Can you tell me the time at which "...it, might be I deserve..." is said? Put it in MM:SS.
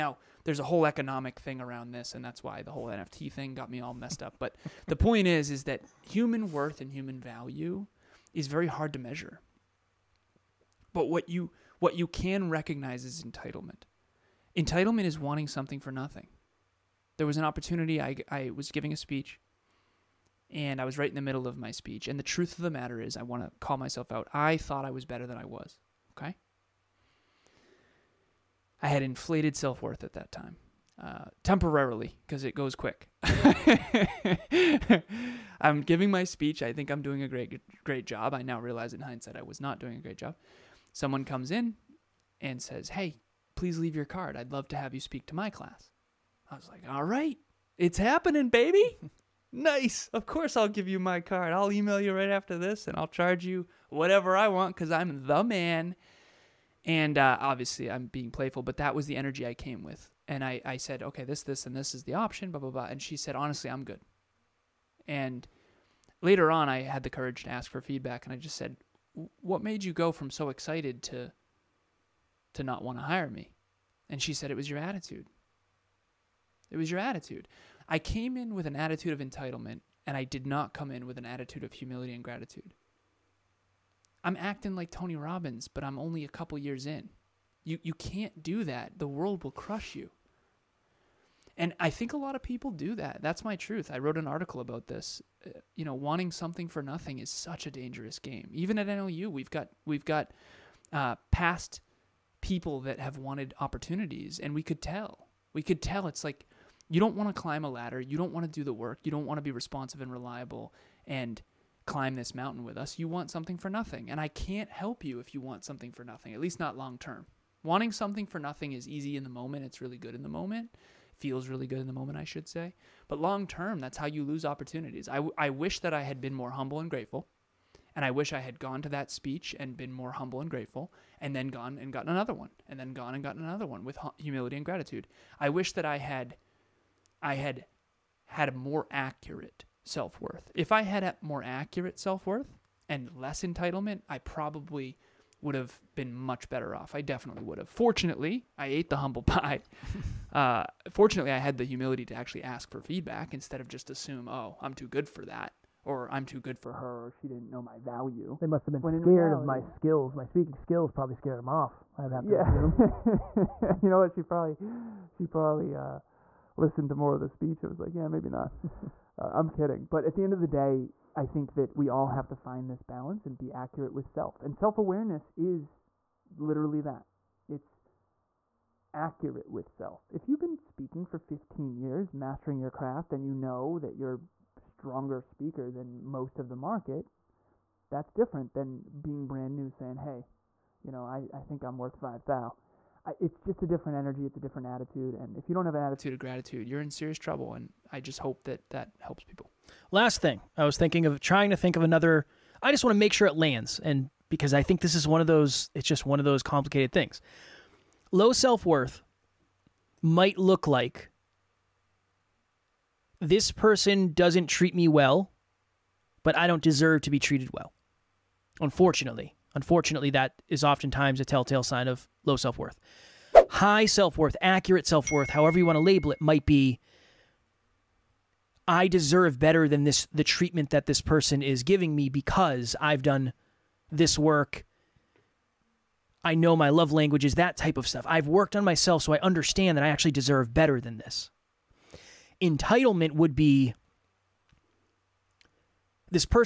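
03:46.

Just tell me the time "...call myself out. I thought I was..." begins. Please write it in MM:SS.
00:23.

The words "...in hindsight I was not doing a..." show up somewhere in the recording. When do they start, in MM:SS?
00:38.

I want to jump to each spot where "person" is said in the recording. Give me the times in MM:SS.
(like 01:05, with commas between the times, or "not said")
03:33, 03:51.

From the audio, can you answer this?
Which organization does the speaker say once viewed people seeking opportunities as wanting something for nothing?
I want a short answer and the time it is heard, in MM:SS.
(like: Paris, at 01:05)
NLU, at 01:38.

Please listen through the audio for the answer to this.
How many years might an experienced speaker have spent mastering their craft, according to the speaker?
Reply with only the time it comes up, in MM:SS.
03:01.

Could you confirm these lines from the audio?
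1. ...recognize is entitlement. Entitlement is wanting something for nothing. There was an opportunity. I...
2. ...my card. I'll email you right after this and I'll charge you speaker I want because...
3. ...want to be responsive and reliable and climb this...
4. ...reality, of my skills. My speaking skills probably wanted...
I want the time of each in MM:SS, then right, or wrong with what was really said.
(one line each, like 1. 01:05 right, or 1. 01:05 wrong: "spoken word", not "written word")
1. 00:12 right
2. 00:50 wrong: "whatever", not "speaker"
3. 01:49 right
4. 02:39 wrong: "scared", not "wanted".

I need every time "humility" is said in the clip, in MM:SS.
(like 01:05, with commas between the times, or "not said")
01:21, 02:14, 02:31.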